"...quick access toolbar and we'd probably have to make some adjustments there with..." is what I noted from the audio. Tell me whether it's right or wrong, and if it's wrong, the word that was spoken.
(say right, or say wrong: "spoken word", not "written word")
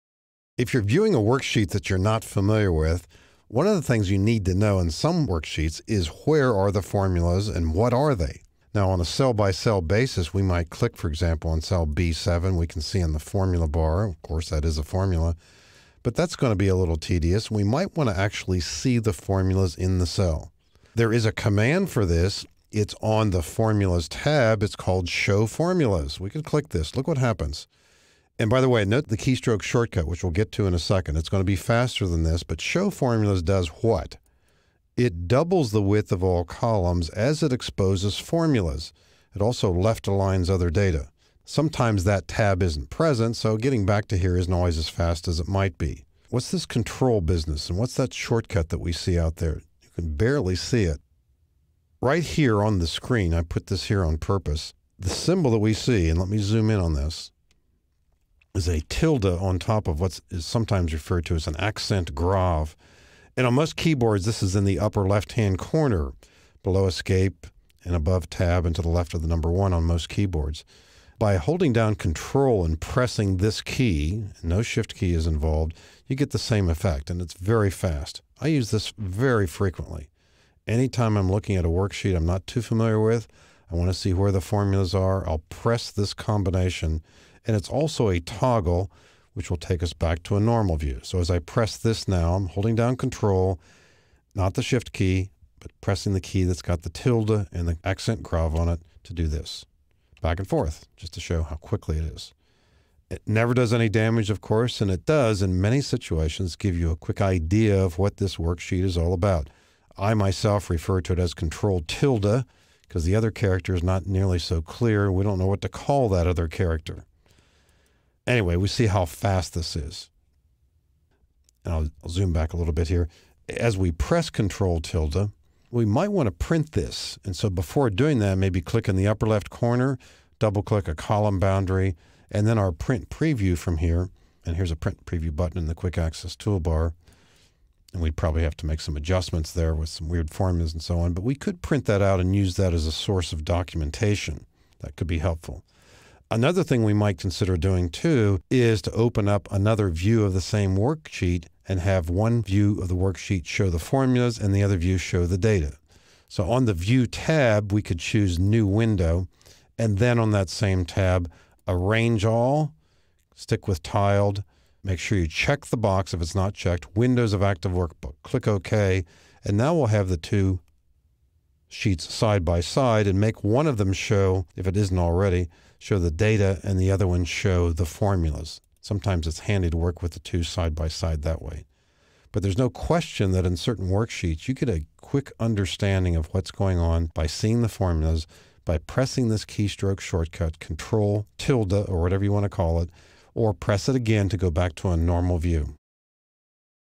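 right.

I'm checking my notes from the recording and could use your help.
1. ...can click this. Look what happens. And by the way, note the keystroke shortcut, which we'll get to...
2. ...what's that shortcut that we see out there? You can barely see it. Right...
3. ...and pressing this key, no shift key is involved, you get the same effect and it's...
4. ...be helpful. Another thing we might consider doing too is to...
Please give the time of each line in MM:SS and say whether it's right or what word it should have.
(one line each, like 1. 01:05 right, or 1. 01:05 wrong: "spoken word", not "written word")
1. 00:26 right
2. 00:47 right
3. 01:12 right
4. 02:25 right.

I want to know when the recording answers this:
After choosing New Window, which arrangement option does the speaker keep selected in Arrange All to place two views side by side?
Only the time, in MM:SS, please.
02:43.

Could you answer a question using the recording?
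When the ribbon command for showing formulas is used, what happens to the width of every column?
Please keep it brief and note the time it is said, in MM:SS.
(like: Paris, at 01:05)
It doubles, at 00:35.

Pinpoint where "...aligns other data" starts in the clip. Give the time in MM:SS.
00:40.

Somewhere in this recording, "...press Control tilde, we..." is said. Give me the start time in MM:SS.
02:03.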